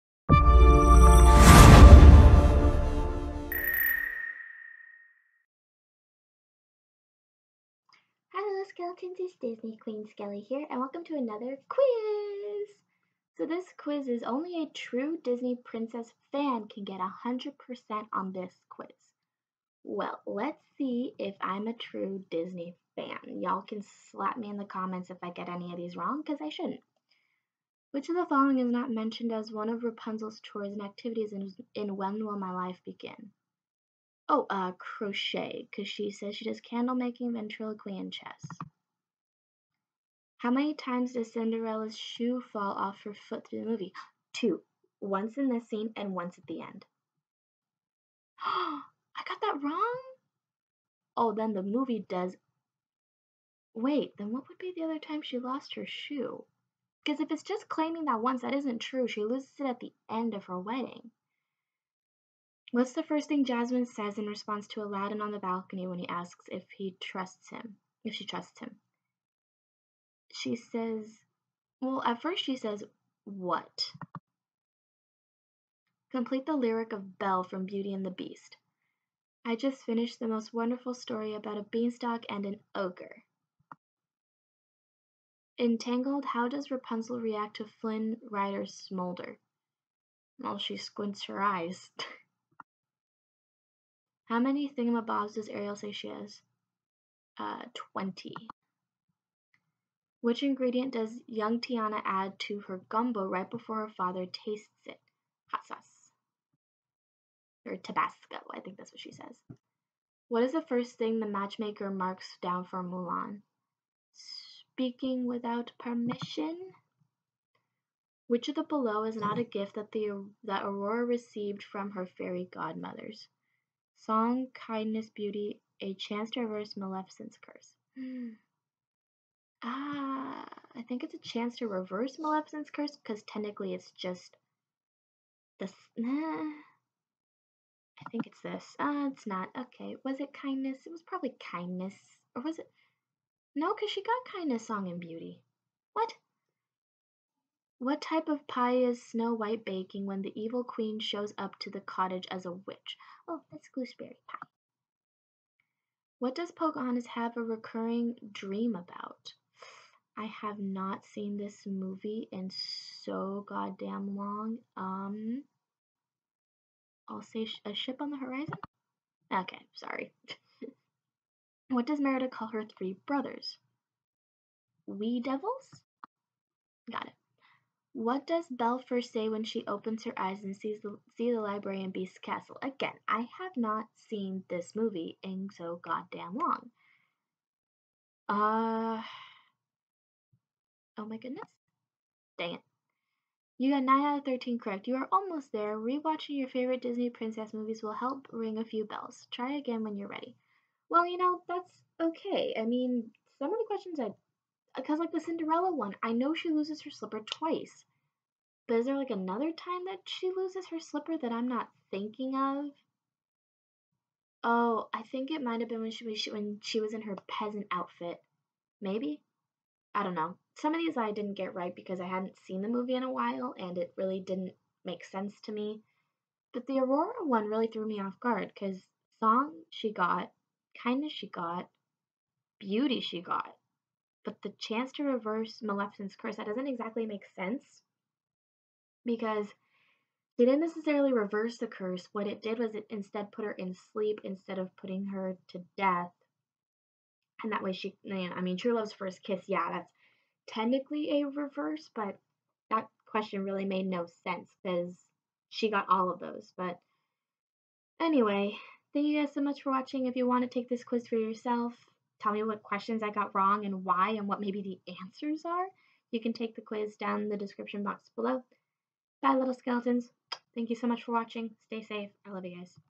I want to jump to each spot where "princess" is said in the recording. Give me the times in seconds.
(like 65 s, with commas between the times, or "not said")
15 s, 197 s.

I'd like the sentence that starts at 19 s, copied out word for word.
Well, let's see if I'm a true Disney fan.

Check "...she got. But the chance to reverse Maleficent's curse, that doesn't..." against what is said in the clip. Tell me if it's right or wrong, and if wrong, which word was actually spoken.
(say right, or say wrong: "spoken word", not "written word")
right.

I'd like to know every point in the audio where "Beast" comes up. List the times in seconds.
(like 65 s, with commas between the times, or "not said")
78 s, 181 s.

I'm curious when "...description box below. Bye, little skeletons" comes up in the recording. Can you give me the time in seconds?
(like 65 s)
267 s.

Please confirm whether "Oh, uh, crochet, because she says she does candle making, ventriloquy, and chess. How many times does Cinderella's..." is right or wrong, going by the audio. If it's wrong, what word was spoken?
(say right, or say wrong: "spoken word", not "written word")
right.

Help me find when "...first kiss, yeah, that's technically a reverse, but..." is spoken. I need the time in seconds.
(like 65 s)
248 s.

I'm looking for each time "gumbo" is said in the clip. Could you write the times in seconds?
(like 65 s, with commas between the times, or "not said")
102 s.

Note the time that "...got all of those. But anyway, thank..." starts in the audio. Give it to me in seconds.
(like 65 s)
255 s.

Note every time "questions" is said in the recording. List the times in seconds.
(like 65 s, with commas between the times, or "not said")
203 s, 253 s, 262 s.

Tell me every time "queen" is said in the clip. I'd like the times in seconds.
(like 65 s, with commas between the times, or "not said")
9 s, 150 s.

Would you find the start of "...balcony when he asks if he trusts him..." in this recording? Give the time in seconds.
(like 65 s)
65 s.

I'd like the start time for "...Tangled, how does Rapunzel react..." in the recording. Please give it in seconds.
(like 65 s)
85 s.